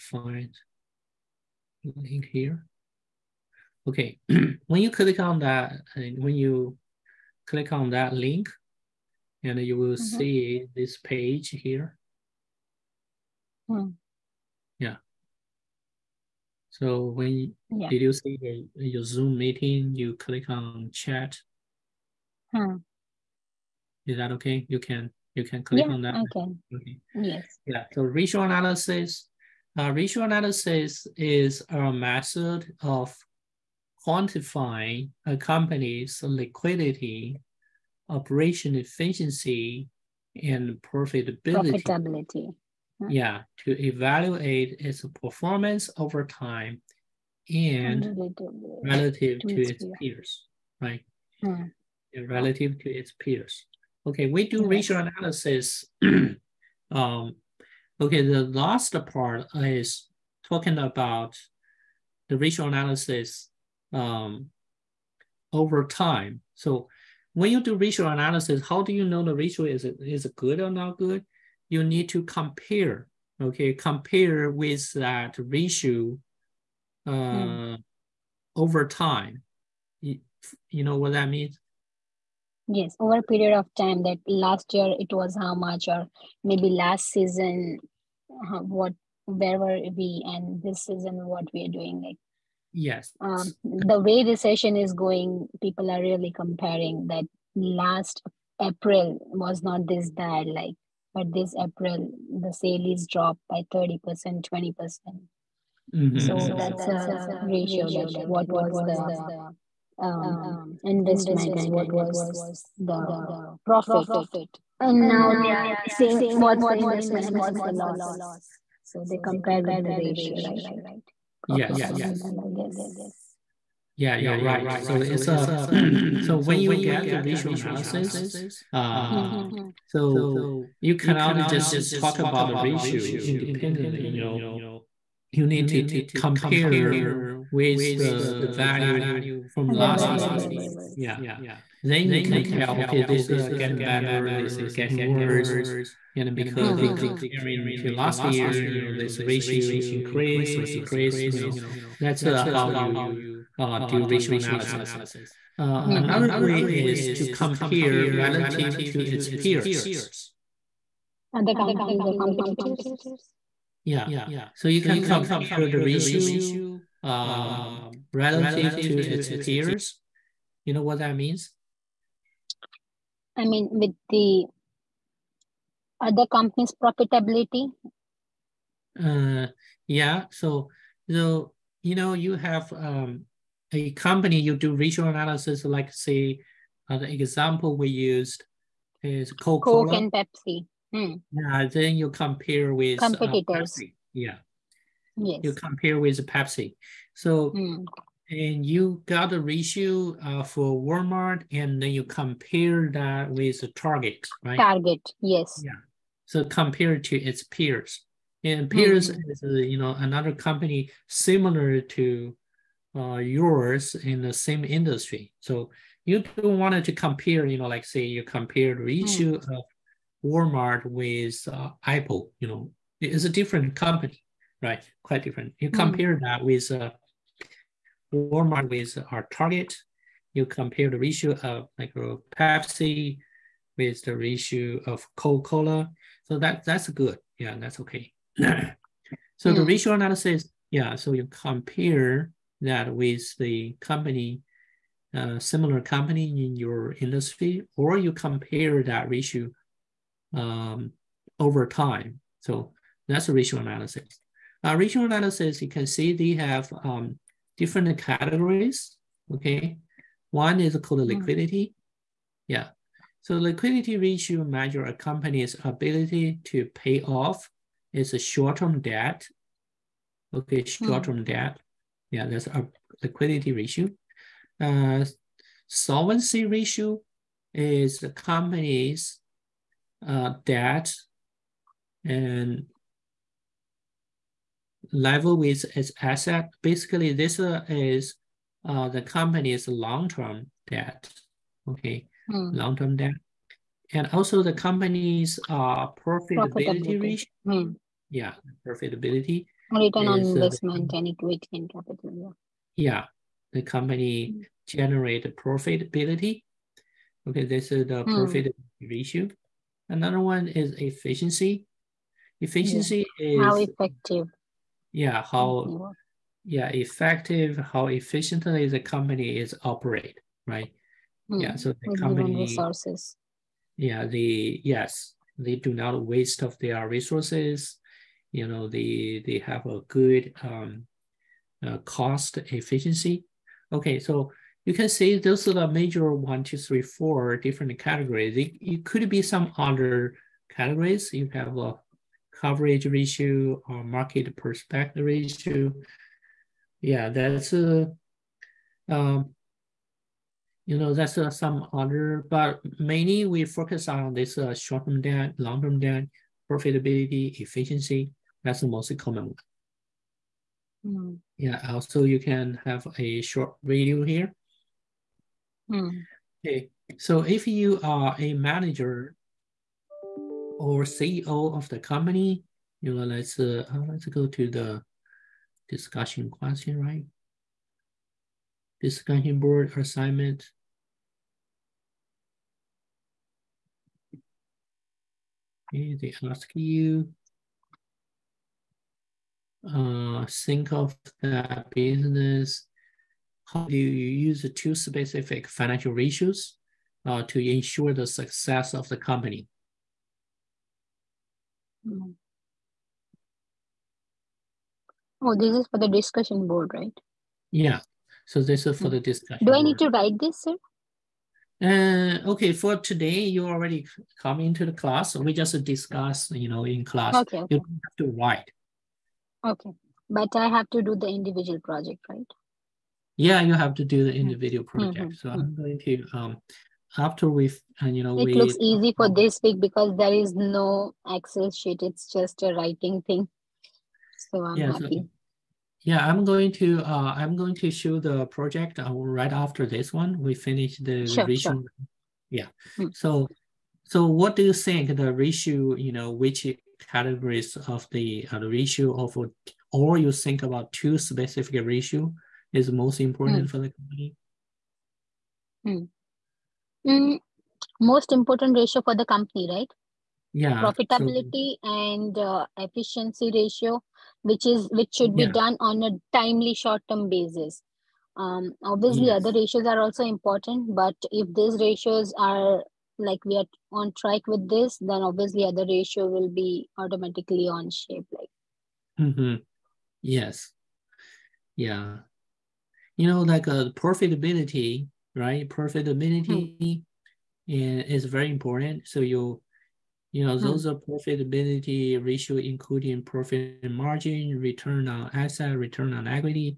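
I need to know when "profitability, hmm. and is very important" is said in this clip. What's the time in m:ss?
8:05.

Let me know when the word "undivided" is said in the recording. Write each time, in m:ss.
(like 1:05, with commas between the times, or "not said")
not said.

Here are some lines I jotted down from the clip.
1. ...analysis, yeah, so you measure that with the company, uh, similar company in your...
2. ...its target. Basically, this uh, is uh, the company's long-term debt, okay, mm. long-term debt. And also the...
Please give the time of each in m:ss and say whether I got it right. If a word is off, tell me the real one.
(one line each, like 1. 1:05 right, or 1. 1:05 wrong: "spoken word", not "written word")
1. 3:59 wrong: "compare", not "measure"
2. 4:45 wrong: "asset", not "target".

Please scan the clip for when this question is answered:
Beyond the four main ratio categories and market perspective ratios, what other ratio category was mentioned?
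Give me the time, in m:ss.
5:42.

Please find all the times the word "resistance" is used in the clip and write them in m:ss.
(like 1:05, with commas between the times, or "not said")
not said.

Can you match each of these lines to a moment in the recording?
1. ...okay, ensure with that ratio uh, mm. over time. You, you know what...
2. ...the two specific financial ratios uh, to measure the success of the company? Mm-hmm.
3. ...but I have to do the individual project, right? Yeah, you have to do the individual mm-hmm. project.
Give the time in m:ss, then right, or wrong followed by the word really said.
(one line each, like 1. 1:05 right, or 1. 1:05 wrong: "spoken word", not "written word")
1. 1:13 wrong: "compare", not "ensure"
2. 6:34 wrong: "ensure", not "measure"
3. 7:00 right.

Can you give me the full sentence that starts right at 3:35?
So you don't want to compare, you know, like say you compare the mm.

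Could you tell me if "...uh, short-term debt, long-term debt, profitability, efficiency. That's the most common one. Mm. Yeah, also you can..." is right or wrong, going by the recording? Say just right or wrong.
right.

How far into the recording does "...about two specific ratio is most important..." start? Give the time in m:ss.
7:30.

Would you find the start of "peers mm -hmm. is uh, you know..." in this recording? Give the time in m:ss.
3:28.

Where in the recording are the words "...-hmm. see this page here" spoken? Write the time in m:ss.
0:09.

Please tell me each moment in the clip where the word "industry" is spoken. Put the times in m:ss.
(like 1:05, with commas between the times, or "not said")
3:34, 4:06.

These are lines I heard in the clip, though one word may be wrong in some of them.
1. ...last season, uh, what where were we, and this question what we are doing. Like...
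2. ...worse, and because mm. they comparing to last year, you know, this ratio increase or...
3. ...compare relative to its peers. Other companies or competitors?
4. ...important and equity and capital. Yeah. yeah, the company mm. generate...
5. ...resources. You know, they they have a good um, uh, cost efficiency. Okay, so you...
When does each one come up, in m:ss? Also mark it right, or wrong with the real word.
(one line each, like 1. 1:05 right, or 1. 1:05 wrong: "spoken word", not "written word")
1. 1:26 wrong: "season", not "question"
2. 2:25 right
3. 2:37 right
4. 5:00 wrong: "investment", not "important"
5. 5:26 right.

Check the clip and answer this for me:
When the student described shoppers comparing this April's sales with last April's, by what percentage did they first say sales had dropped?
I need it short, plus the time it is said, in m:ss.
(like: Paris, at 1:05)
30%, at 1:43.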